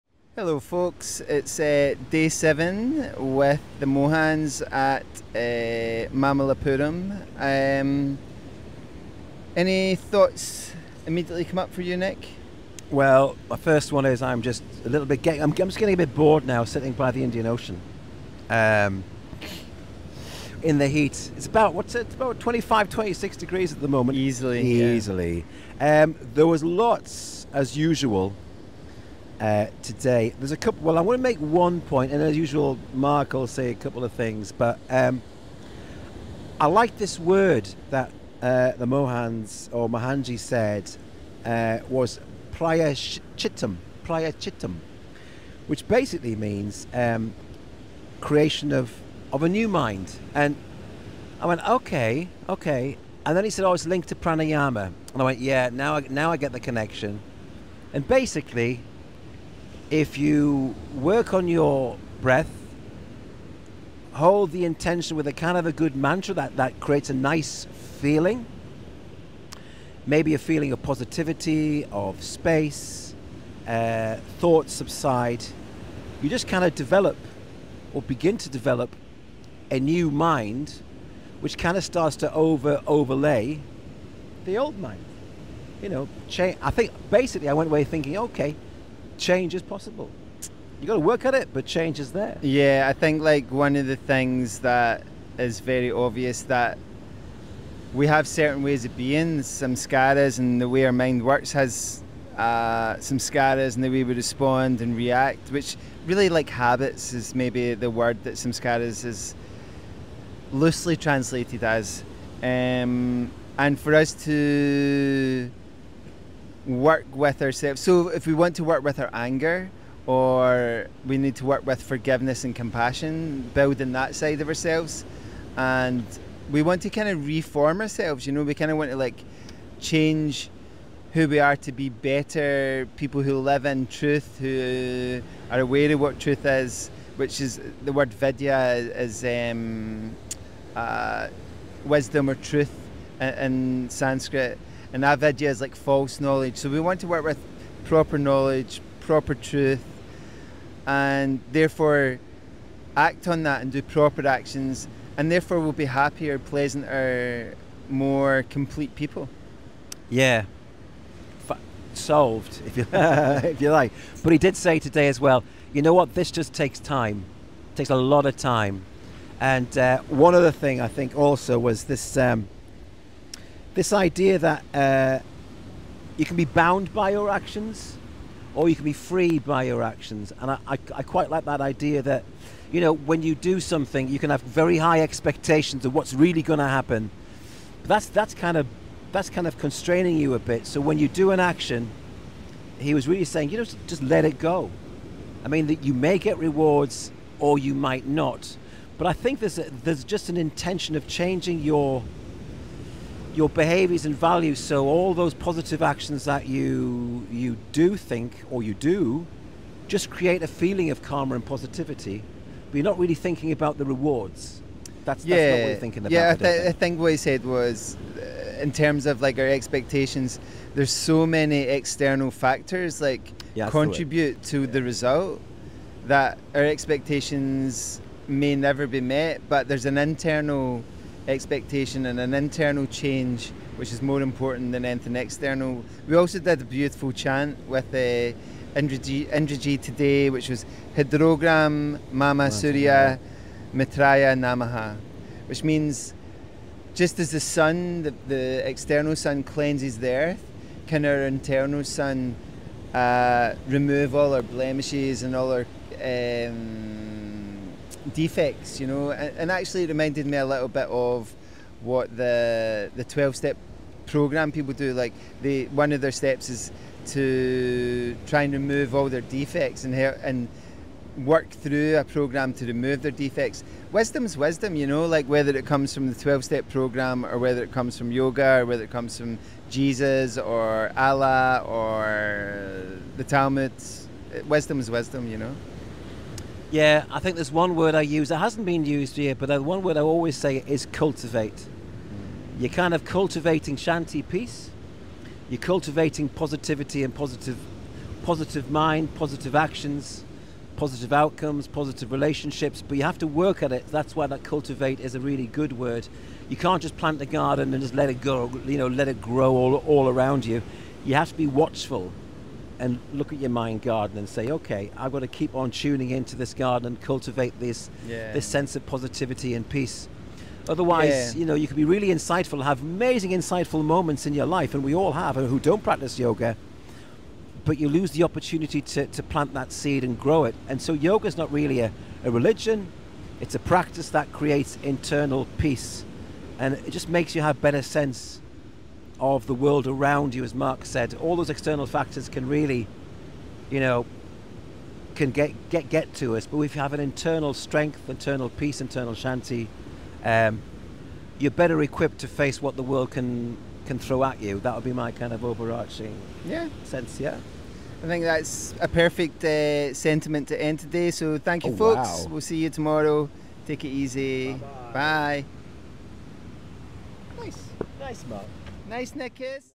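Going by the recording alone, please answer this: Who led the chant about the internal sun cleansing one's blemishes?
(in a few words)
Indraji.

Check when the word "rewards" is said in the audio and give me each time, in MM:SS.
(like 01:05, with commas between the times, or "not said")
03:16, 03:33.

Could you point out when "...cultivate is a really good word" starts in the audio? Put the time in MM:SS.
05:04.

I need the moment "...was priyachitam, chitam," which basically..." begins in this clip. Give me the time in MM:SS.
00:41.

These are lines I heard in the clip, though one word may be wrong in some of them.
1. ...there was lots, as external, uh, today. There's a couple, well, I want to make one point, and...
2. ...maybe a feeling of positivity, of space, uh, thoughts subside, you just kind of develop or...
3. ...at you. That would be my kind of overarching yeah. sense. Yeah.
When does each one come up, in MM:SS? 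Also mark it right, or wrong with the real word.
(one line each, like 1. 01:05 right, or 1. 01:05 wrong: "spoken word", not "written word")
1. 00:26 wrong: "usual", not "external"
2. 01:10 right
3. 05:54 right.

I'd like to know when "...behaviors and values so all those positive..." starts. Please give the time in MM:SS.
03:23.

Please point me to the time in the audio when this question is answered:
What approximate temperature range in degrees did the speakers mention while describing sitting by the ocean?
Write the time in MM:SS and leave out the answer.
00:22.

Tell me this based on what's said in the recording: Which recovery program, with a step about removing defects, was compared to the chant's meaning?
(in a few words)
twelve step program.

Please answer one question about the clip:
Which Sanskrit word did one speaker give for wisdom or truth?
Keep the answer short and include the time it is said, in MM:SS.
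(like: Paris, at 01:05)
vidya, at 02:18.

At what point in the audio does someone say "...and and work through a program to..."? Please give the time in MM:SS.
04:29.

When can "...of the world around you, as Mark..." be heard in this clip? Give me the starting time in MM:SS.
05:39.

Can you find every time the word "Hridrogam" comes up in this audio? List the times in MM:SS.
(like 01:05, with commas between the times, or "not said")
04:00.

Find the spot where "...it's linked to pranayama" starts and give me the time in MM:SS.
00:53.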